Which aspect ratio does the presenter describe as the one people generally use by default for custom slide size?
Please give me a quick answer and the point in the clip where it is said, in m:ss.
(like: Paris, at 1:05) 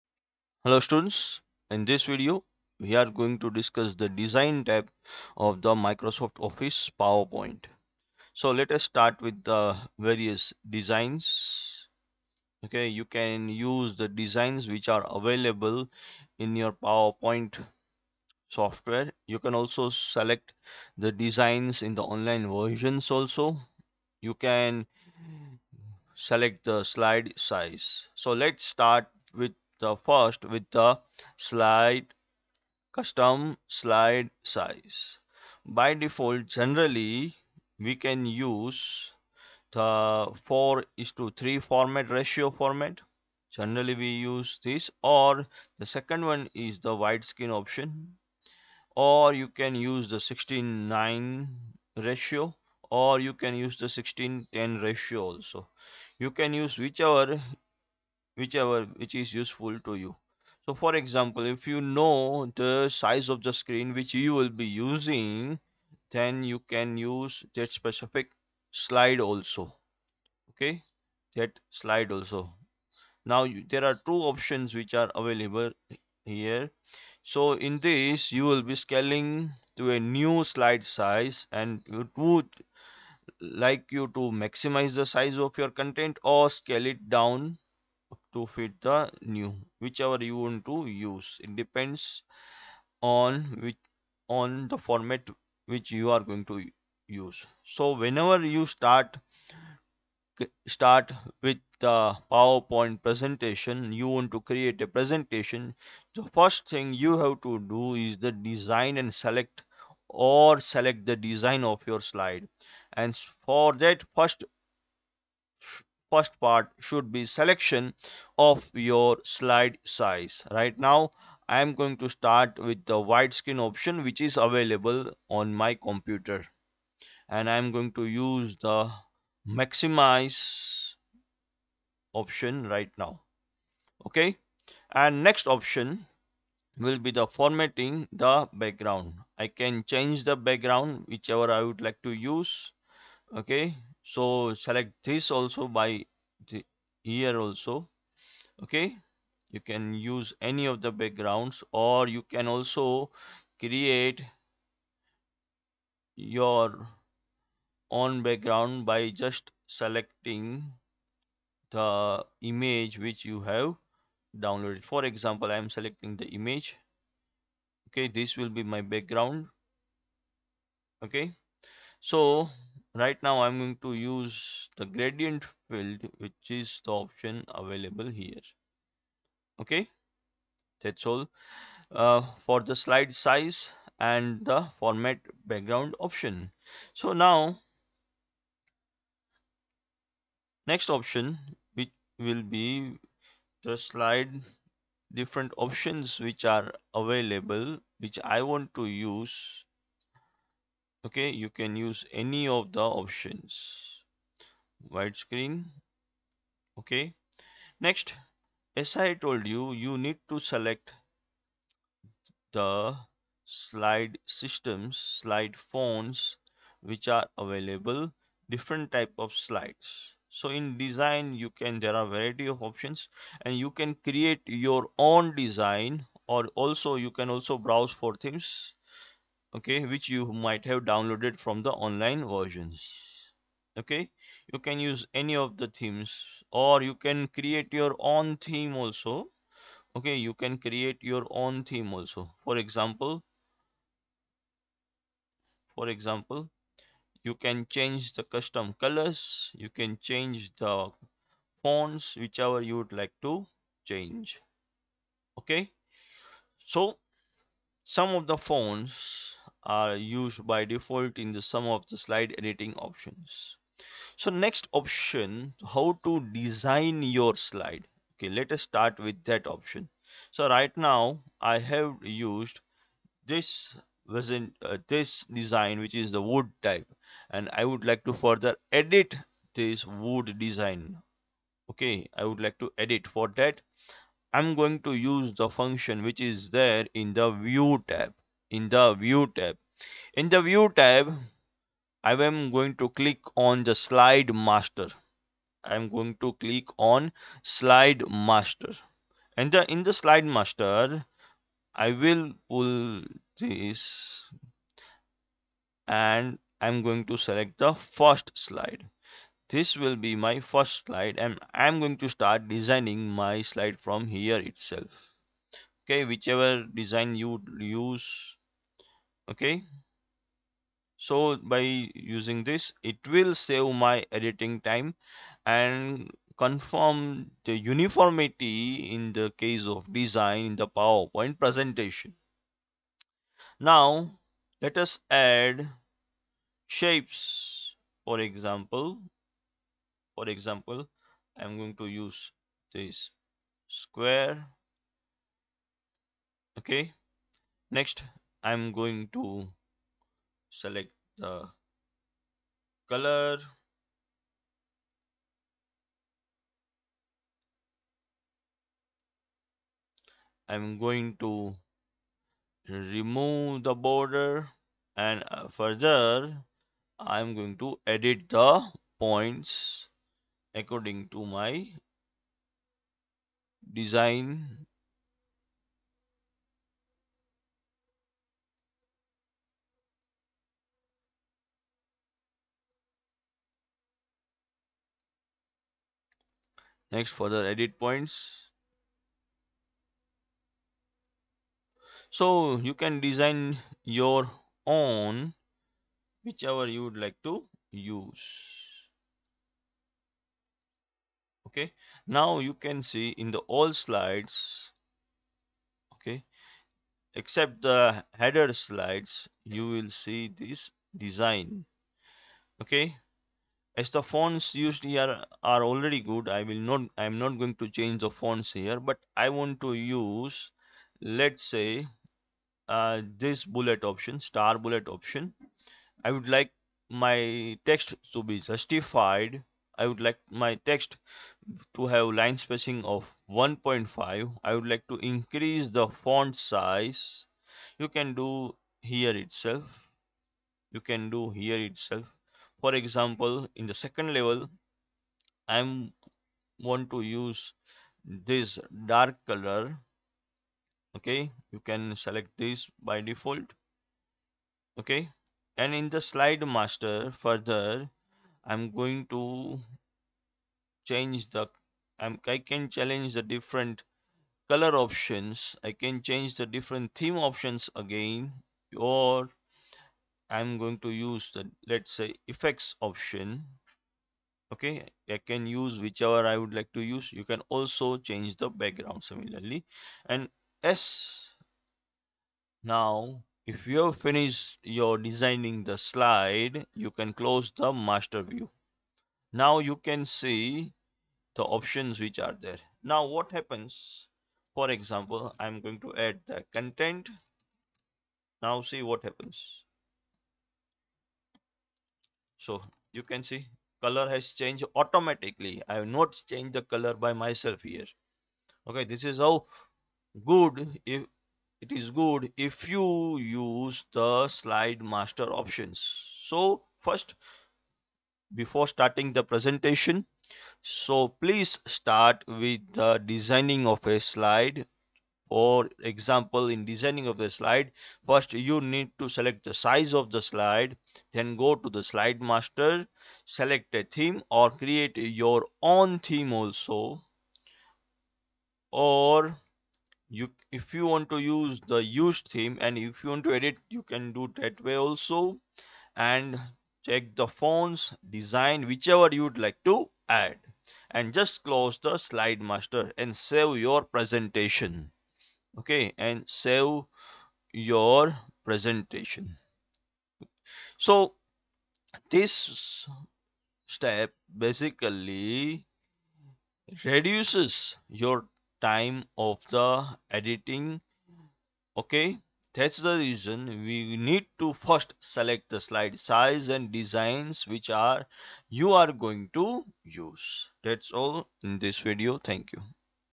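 4:3, at 0:40.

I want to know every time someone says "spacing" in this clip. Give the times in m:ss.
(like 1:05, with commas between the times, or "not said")
7:12.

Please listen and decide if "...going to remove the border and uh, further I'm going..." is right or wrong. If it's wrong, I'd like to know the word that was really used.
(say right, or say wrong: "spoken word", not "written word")
right.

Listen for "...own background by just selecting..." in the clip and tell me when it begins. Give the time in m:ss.
2:37.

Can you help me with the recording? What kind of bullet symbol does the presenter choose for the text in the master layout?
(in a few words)
Star bullet.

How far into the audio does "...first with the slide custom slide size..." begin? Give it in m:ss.
0:30.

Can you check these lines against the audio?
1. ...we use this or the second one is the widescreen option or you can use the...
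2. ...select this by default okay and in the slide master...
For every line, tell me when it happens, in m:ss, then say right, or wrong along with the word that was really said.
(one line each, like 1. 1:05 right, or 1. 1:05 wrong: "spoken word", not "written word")
1. 0:44 right
2. 7:32 right.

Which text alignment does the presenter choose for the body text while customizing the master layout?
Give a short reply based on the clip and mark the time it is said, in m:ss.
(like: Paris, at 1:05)
Justified, at 7:08.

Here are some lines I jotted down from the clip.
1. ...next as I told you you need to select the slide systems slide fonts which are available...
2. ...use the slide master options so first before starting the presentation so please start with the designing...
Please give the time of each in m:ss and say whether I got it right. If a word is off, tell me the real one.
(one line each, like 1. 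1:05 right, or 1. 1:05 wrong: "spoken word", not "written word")
1. 3:27 right
2. 8:33 right.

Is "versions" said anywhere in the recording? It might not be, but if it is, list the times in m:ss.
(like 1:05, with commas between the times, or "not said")
0:22, 3:52.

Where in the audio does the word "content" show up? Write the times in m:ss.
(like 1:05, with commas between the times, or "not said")
1:25, 8:16.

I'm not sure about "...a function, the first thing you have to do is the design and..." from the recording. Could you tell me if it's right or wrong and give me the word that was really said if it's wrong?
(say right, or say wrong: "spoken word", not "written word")
wrong: "presentation", not "function".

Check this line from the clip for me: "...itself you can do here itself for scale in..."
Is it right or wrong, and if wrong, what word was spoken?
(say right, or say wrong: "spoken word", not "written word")
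wrong: "example", not "scale".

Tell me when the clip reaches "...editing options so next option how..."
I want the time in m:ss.
4:22.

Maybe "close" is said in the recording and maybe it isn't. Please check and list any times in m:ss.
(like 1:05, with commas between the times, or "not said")
8:07, 9:11.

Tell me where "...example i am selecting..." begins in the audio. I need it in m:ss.
2:45.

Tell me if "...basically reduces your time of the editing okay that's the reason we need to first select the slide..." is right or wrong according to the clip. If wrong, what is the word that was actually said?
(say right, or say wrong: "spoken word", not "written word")
right.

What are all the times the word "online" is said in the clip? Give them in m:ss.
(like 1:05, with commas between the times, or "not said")
0:22, 3:51.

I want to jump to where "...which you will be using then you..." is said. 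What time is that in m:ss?
1:03.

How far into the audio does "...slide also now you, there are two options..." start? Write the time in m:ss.
1:11.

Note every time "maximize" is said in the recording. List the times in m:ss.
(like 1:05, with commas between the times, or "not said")
1:24, 2:09.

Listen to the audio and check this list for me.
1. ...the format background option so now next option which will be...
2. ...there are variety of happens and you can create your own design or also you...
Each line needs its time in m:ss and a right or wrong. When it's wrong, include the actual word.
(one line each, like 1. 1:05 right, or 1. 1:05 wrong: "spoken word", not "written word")
1. 3:04 right
2. 3:41 wrong: "options", not "happens".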